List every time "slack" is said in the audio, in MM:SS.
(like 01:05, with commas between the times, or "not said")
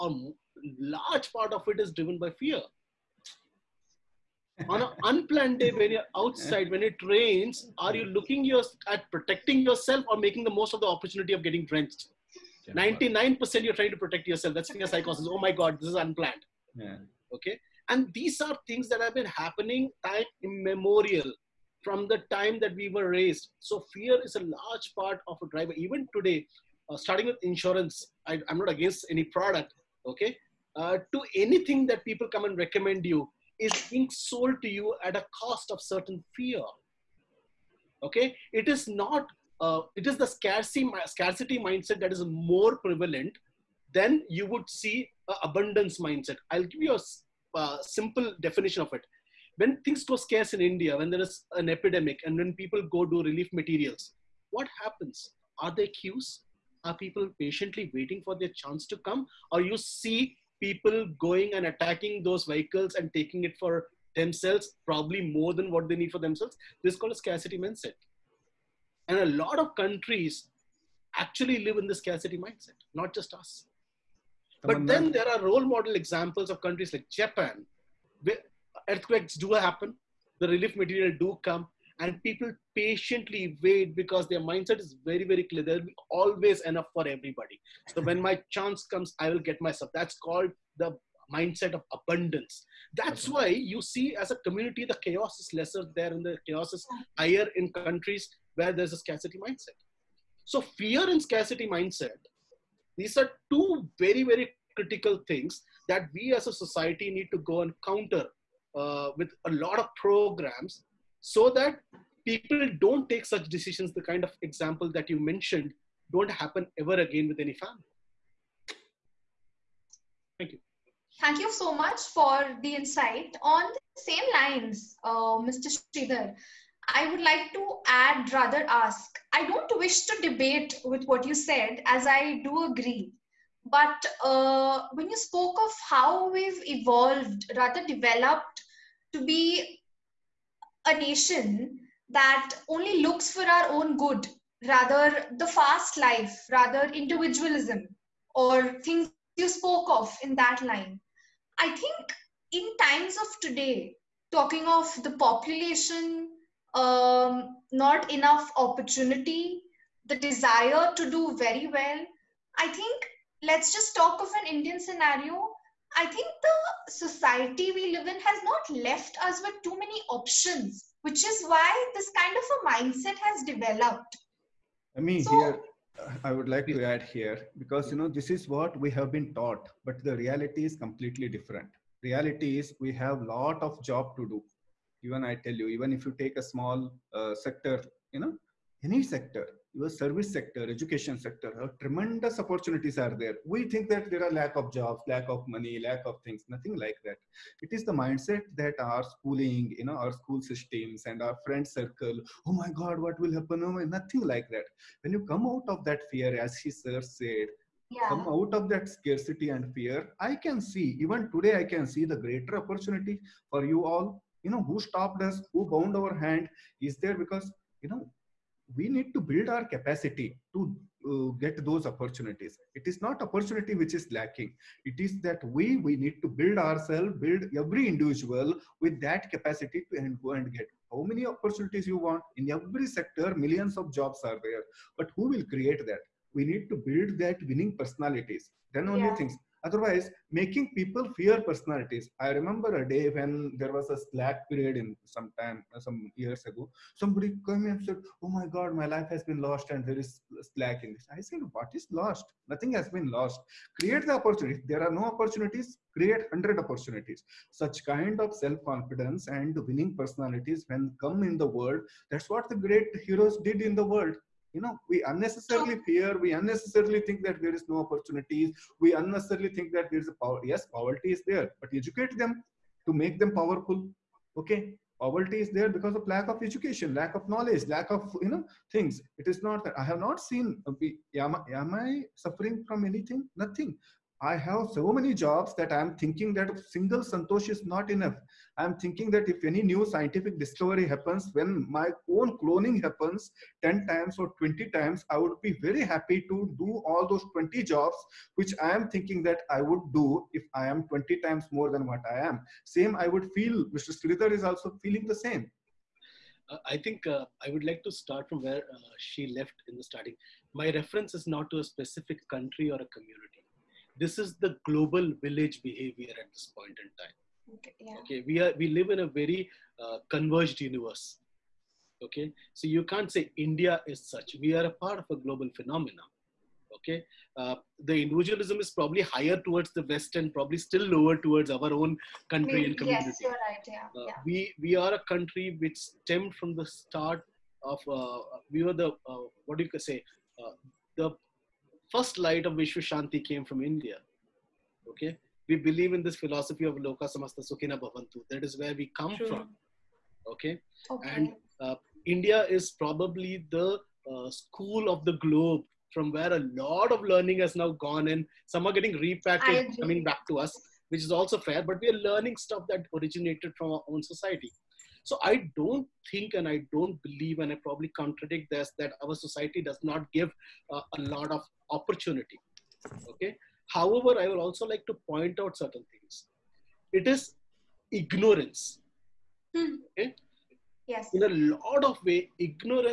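04:03, 04:10.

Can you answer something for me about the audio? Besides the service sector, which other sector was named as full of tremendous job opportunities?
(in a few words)
Education sector.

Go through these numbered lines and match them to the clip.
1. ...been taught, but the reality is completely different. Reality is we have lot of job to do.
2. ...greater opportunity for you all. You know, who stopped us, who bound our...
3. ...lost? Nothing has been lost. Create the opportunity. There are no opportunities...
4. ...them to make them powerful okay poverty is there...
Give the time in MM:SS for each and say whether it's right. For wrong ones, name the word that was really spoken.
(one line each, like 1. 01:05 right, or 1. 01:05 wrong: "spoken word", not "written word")
1. 02:59 right
2. 03:32 right
3. 04:11 right
4. 04:32 right.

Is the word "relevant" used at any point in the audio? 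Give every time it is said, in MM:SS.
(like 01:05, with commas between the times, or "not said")
not said.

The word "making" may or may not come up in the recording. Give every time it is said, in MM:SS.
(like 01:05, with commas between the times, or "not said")
00:10, 04:00.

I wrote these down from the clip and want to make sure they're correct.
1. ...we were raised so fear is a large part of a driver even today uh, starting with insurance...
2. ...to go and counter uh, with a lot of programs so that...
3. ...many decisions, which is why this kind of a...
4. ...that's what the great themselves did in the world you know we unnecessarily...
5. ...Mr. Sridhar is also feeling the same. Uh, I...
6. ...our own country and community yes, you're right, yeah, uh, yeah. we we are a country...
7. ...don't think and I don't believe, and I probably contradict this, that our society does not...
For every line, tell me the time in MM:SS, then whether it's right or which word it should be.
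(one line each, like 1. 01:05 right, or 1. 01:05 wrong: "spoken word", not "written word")
1. 00:22 right
2. 01:47 right
3. 02:49 wrong: "options", not "decisions"
4. 04:22 wrong: "heroes", not "themselves"
5. 05:03 right
6. 05:31 right
7. 06:05 right.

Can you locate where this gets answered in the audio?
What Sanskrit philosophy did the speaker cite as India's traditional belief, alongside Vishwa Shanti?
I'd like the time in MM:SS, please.
05:46.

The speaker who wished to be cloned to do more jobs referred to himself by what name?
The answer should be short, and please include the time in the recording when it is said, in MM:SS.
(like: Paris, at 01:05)
Santosh, at 04:47.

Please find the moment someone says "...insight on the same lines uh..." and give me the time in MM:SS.
02:02.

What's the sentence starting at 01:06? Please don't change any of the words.
This is called a scarcity mindset.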